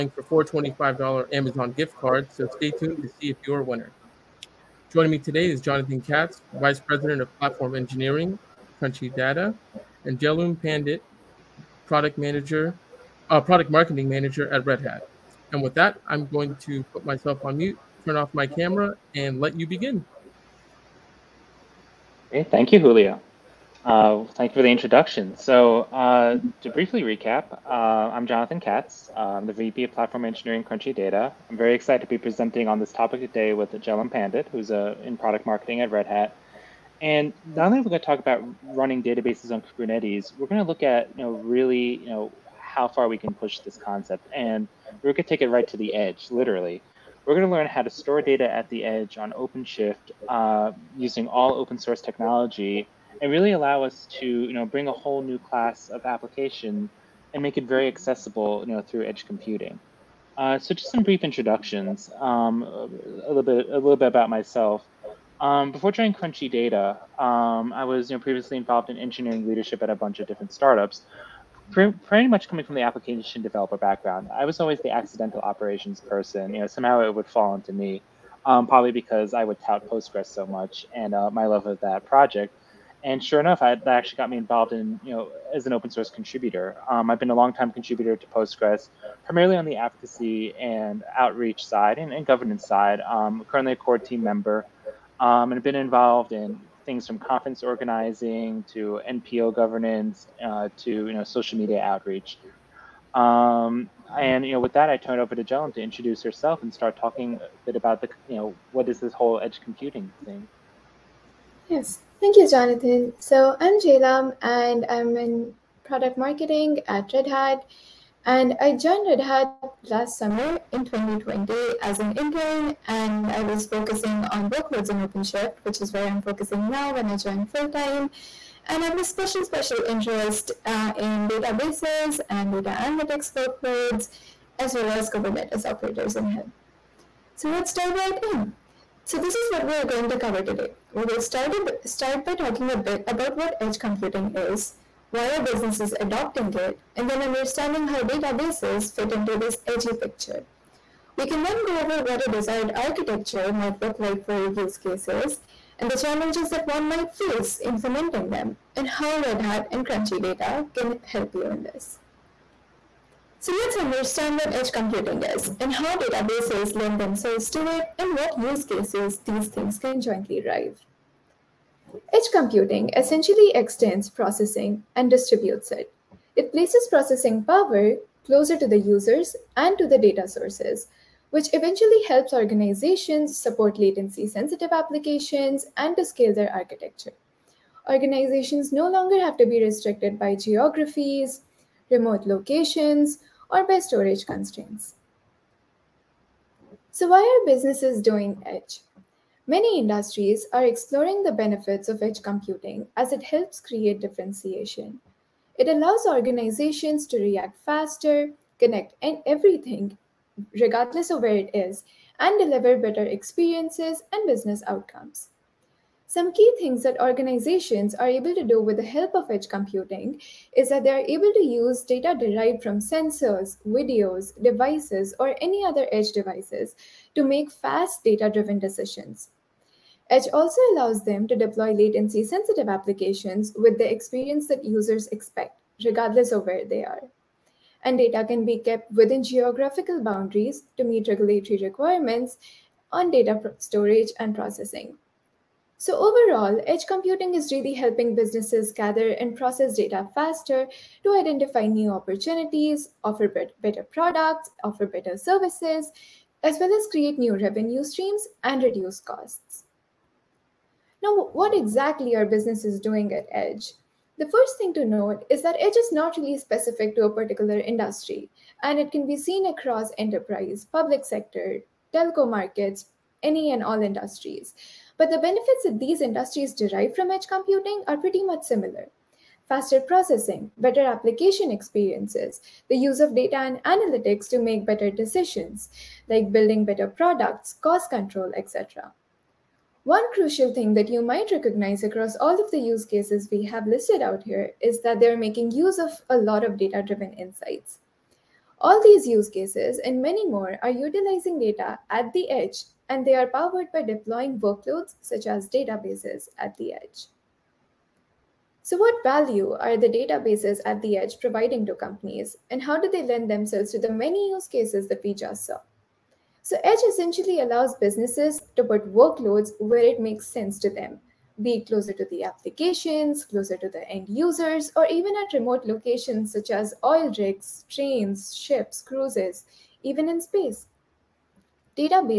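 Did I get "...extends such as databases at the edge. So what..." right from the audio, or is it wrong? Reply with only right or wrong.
wrong.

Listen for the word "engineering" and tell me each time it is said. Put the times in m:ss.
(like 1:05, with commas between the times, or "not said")
0:07, 0:30, 1:08.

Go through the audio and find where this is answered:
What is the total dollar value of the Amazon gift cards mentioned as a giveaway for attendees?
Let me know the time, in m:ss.
0:00.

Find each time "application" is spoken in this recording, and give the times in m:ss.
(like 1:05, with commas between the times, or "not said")
0:56, 1:12, 3:04, 3:52, 4:40, 5:22.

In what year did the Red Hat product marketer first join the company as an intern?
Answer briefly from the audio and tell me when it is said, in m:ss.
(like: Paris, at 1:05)
2020, at 2:00.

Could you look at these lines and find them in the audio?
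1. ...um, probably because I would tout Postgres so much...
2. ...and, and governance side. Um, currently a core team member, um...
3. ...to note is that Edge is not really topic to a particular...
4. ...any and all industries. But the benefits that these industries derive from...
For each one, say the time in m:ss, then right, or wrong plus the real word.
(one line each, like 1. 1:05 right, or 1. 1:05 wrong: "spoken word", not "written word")
1. 1:18 right
2. 1:31 right
3. 4:24 wrong: "specific", not "topic"
4. 4:33 right.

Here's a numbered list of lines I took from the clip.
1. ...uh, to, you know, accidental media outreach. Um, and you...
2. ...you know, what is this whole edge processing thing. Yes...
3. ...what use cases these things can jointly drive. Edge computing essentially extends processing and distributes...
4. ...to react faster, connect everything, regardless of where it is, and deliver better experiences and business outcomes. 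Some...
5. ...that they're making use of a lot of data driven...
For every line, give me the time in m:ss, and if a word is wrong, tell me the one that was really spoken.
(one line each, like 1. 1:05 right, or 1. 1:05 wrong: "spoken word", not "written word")
1. 1:40 wrong: "social", not "accidental"
2. 1:48 wrong: "computing", not "processing"
3. 2:48 right
4. 3:27 right
5. 4:54 right.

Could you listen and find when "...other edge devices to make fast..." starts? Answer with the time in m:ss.
3:45.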